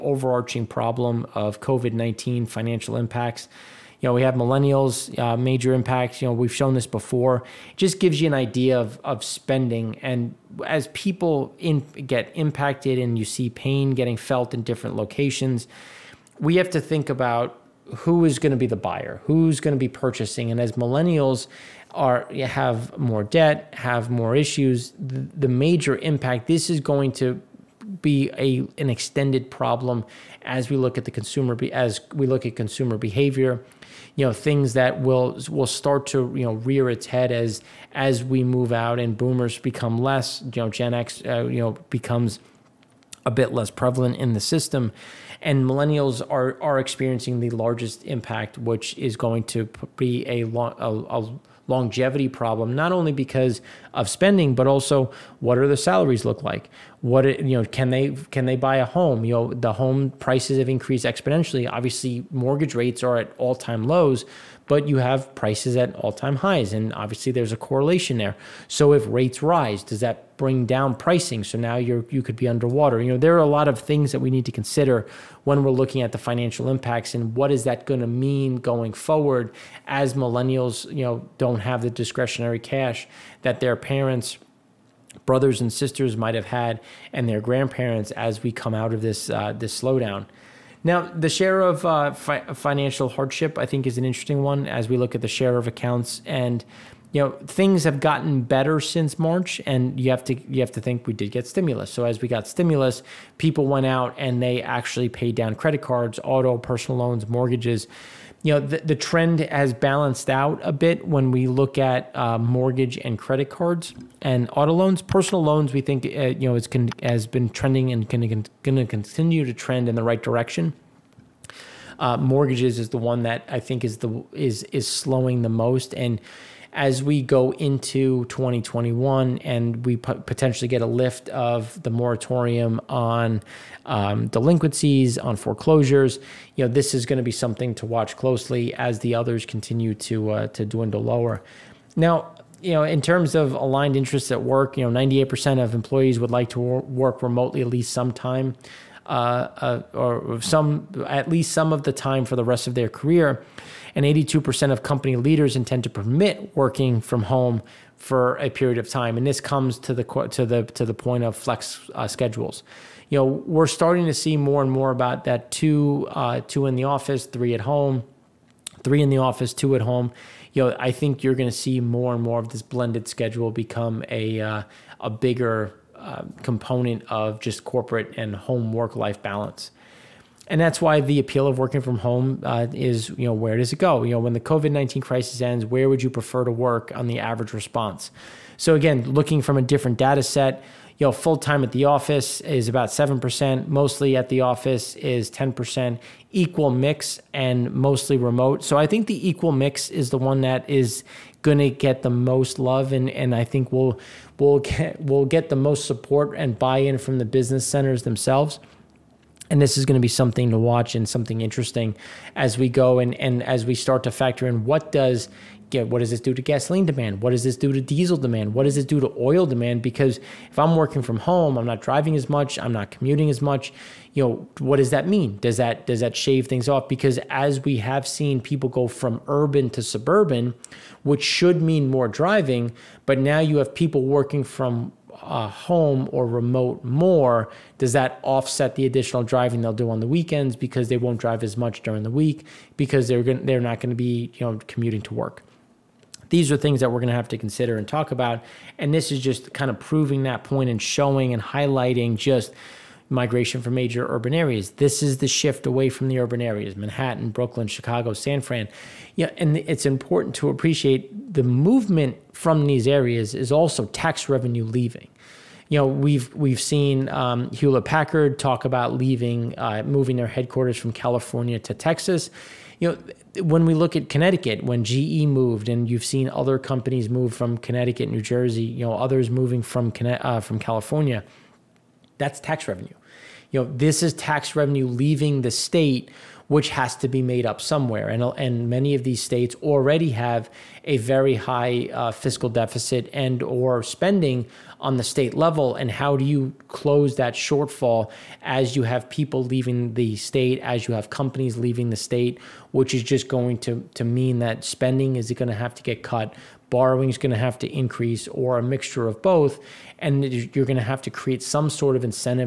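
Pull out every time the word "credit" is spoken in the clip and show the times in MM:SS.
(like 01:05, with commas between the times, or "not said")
01:45, 01:53.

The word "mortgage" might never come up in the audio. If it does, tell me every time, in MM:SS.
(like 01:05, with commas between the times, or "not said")
01:02, 01:47, 01:52, 02:02.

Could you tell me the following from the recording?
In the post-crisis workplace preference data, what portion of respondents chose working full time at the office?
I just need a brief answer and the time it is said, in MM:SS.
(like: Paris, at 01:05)
7%, at 03:12.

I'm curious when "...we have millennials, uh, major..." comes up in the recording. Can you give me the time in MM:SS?
00:04.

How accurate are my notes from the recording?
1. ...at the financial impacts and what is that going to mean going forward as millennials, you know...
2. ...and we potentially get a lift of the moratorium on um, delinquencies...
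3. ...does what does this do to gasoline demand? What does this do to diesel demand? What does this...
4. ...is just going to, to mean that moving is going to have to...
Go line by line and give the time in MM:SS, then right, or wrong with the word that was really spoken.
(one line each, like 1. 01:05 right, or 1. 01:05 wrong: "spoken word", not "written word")
1. 01:16 right
2. 02:09 right
3. 03:34 right
4. 05:02 wrong: "spending", not "moving".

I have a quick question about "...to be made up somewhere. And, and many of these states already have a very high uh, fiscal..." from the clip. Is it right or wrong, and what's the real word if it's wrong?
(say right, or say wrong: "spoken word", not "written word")
right.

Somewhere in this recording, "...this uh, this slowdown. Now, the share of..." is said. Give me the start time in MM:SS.
01:29.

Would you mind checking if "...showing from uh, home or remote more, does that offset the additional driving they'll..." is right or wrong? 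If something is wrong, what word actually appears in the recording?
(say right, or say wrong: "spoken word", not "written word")
wrong: "working", not "showing".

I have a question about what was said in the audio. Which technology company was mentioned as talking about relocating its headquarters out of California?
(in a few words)
Hewlett Packard.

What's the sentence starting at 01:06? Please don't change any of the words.
And obviously, there's a correlation there.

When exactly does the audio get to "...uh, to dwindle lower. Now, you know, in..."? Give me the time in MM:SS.
02:20.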